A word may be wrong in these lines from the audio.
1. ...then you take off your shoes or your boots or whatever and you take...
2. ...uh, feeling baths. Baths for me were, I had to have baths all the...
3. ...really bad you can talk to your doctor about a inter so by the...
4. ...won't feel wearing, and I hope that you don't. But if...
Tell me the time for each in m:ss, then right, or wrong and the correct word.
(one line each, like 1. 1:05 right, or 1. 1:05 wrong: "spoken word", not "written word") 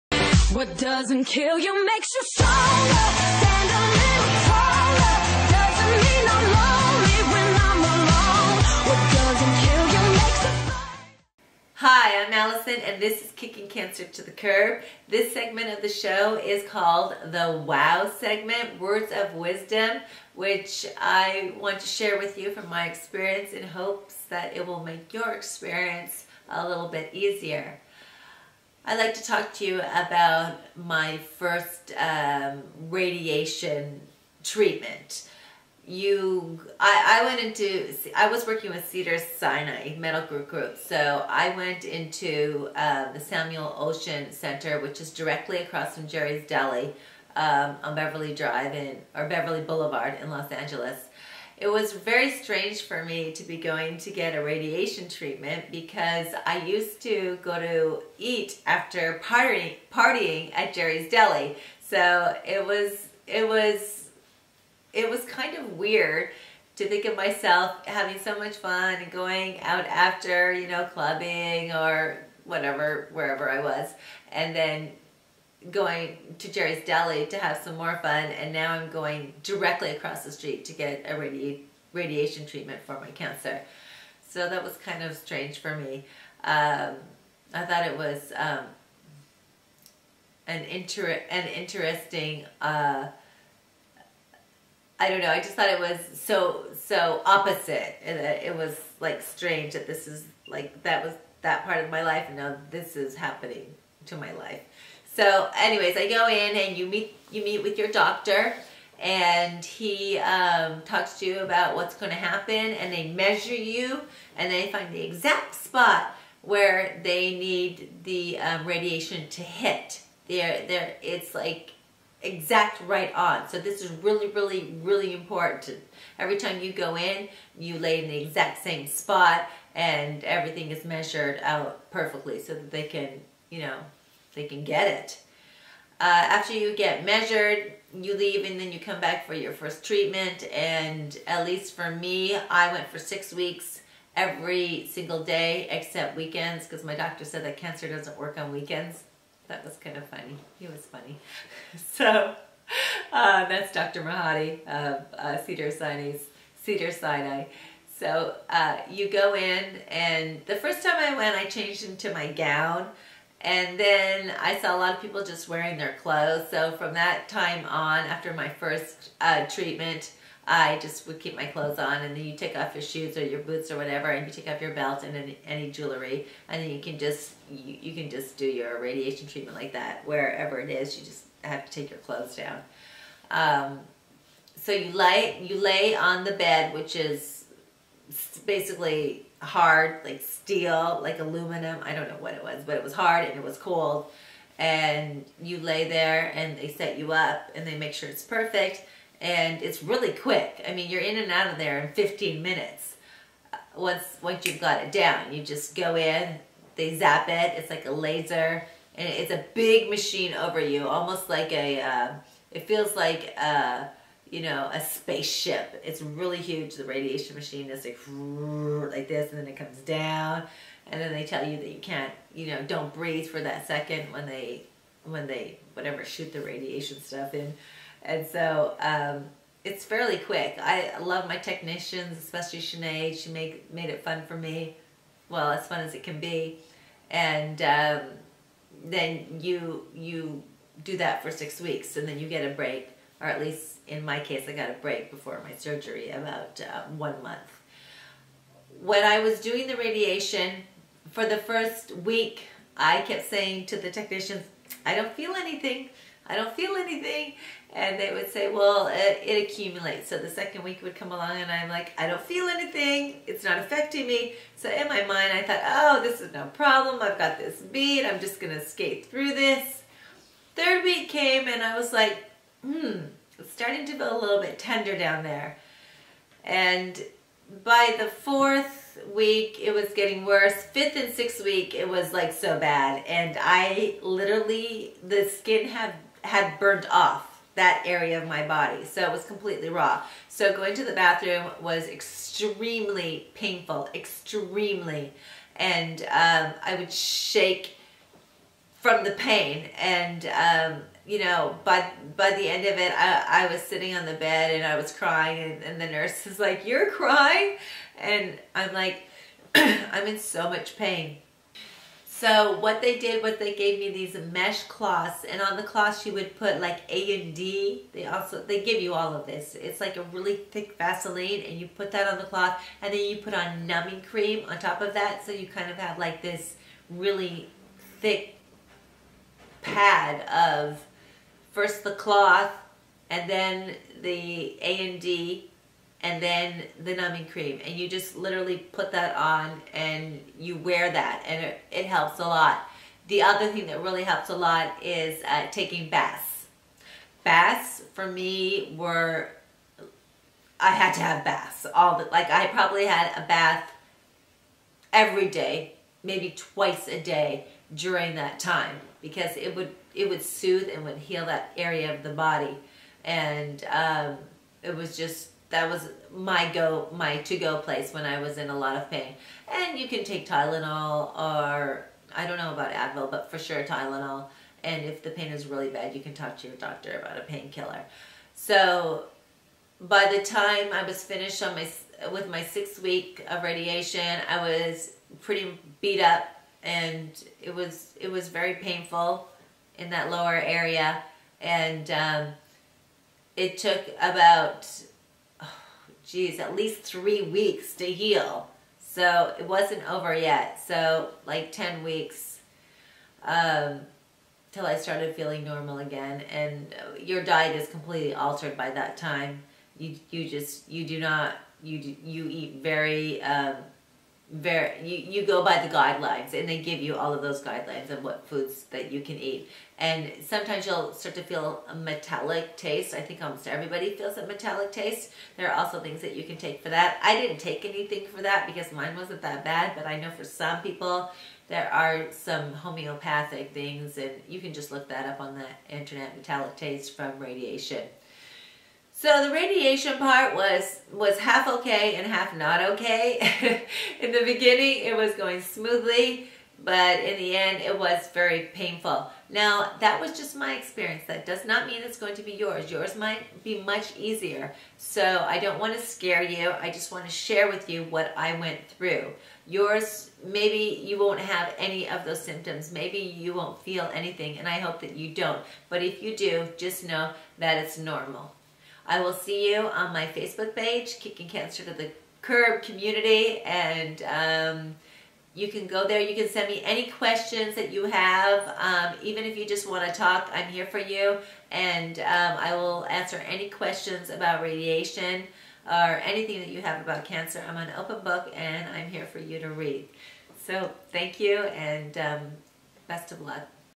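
1. 2:52 right
2. 5:45 wrong: "taking", not "feeling"
3. 6:15 wrong: "painkiller", not "inter"
4. 7:43 wrong: "anything", not "wearing".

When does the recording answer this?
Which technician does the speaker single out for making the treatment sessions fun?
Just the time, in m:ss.
3:52.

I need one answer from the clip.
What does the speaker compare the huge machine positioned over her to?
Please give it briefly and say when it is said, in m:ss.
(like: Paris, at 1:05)
A spaceship, at 3:34.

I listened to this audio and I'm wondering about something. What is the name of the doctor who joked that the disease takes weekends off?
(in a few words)
Dr. Mahadi.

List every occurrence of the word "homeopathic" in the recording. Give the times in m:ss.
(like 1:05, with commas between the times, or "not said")
7:12.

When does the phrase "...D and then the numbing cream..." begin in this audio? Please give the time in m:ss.
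5:35.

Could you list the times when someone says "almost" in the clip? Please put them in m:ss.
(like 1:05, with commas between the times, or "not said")
3:30, 7:03.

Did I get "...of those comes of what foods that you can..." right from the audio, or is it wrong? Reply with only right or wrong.
wrong.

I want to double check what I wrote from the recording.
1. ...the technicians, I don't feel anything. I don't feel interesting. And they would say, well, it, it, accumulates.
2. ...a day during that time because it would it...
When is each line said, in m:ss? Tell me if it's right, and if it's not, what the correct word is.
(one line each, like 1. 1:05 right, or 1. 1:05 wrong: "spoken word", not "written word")
1. 4:13 wrong: "anything", not "interesting"
2. 5:56 right.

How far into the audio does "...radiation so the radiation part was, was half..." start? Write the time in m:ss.
7:17.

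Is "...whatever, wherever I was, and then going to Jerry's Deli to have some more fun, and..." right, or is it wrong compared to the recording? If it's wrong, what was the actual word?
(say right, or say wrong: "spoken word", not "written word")
right.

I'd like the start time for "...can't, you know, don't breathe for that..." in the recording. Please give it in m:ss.
3:41.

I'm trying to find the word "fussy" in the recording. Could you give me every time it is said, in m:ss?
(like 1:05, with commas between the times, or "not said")
not said.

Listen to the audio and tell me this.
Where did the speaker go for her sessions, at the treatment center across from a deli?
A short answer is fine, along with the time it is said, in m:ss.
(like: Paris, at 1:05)
Samuel Oschin Center, at 0:43.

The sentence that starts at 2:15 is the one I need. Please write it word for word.
Uh, after you get measured, you leave and then you come back for your first treatment.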